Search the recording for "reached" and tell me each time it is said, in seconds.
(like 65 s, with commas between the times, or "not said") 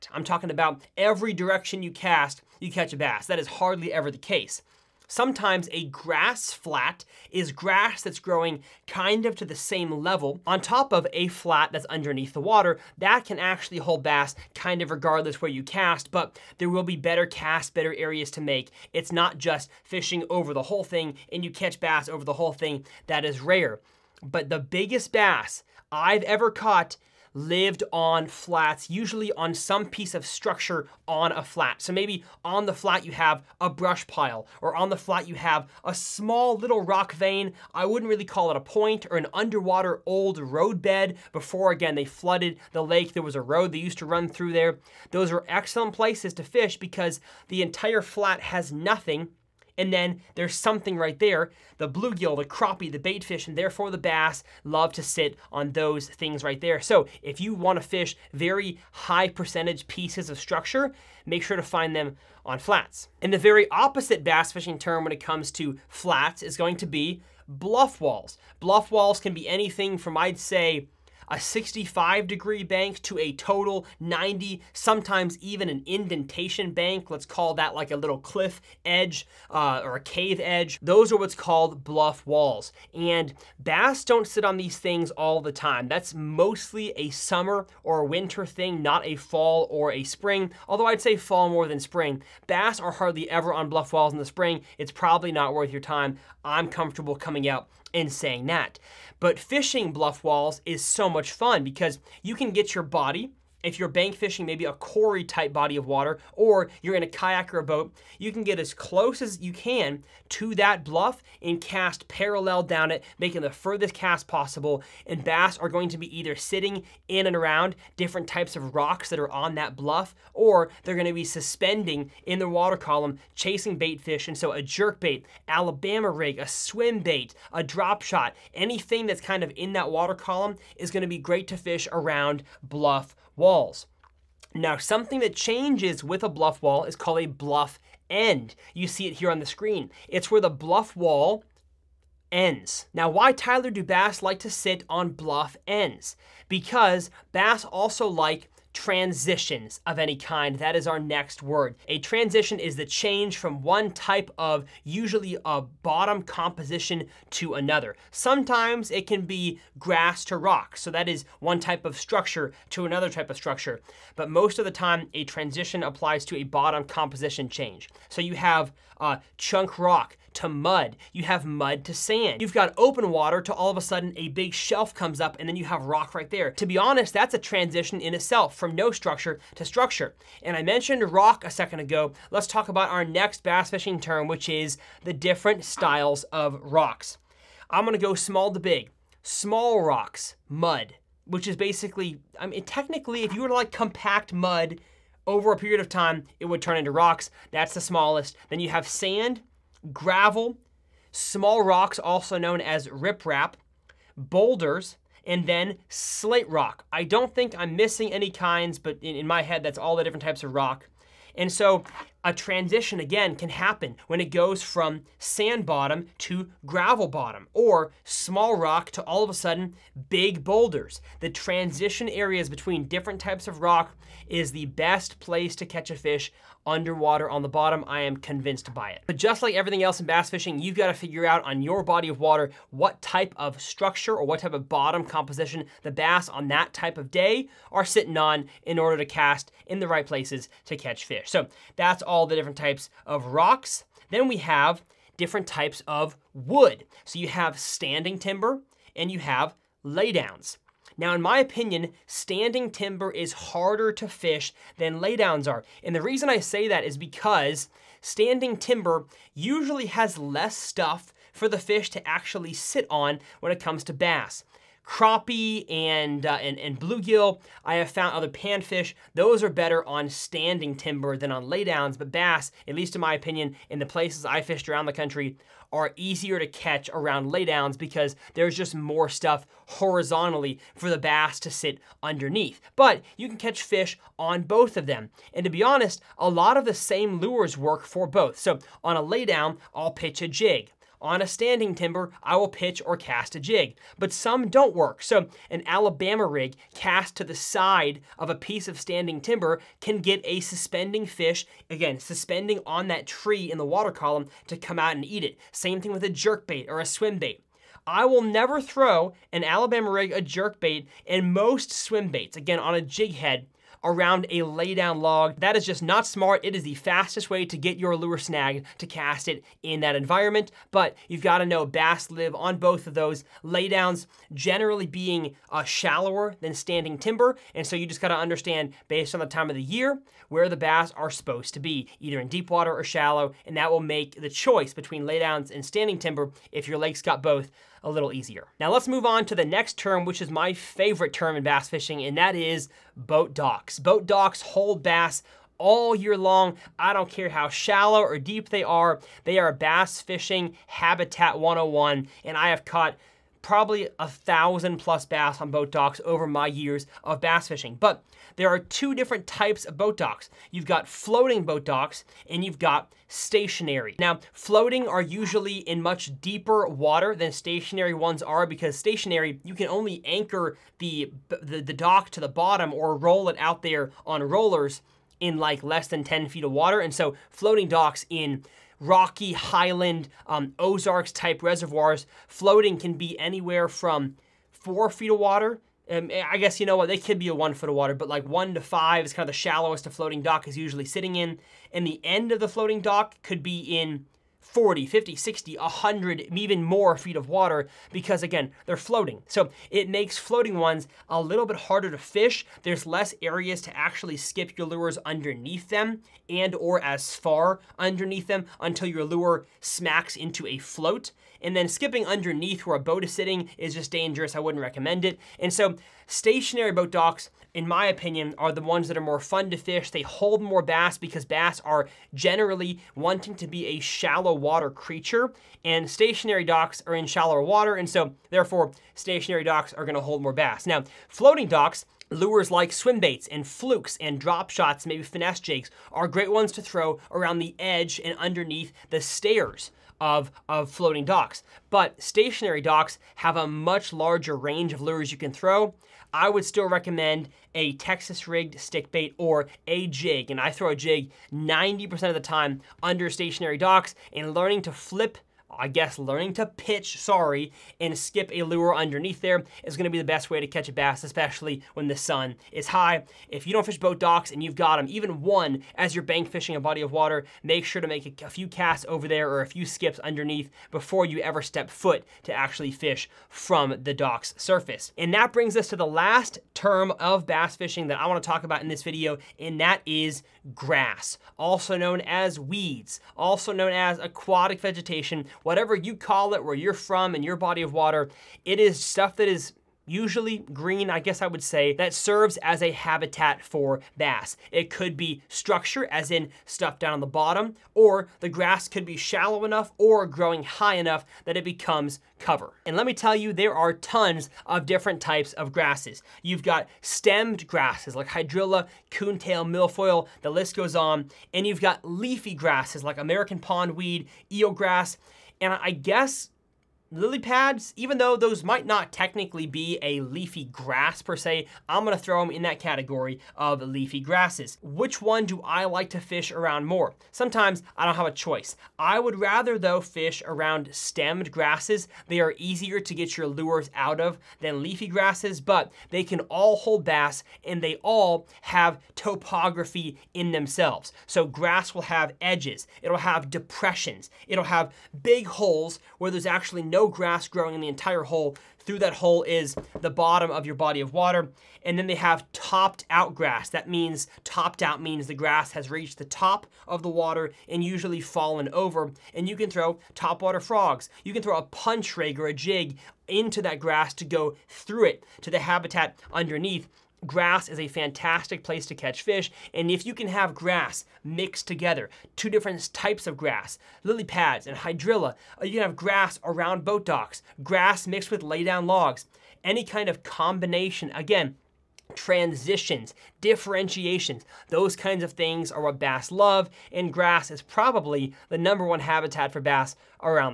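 555 s.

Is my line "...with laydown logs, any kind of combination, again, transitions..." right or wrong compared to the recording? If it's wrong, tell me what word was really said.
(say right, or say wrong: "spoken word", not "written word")
right.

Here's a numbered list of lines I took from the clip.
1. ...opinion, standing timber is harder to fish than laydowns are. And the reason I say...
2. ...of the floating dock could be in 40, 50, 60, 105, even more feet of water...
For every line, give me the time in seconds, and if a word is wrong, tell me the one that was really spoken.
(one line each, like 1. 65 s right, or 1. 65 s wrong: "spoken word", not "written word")
1. 251 s right
2. 392 s wrong: "100", not "105".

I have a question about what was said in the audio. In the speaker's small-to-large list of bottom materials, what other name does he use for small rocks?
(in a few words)
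Riprap.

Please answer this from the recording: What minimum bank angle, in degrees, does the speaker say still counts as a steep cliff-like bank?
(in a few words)
65.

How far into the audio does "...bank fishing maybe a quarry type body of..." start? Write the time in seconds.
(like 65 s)
103 s.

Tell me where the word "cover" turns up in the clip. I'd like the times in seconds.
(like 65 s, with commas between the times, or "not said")
502 s.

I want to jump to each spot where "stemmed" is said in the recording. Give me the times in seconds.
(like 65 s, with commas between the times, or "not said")
506 s, 530 s.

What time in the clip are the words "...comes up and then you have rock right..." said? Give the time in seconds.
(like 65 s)
174 s.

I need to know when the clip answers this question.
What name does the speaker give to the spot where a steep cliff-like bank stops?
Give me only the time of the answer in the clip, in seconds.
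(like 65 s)
137 s.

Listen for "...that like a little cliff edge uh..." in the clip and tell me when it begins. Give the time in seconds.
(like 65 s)
77 s.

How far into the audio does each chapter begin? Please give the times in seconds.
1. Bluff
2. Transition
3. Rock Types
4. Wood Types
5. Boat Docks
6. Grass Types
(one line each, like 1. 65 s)
1. 65 s
2. 147 s
3. 183 s
4. 243 s
5. 341 s
6. 478 s.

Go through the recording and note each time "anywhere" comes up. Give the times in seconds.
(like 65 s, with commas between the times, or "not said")
383 s.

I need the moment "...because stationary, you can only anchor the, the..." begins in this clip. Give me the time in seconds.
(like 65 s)
368 s.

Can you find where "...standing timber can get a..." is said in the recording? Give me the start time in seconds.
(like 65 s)
298 s.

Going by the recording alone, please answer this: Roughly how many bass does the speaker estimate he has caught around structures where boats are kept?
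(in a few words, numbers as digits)
1,000 plus.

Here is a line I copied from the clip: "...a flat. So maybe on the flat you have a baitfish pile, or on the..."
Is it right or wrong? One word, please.
wrong.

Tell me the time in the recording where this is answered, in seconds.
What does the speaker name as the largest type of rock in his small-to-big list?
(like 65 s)
205 s.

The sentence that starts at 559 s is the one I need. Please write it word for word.
And you can throw topwater frogs.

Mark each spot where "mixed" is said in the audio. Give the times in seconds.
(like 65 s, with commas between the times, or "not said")
571 s, 577 s.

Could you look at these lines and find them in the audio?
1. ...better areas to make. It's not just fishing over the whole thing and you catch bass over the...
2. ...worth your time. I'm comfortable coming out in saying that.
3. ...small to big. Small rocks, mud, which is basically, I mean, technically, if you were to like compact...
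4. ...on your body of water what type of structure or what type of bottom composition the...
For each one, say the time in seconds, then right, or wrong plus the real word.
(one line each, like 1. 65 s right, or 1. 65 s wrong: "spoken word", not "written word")
1. 17 s right
2. 95 s right
3. 188 s right
4. 231 s right.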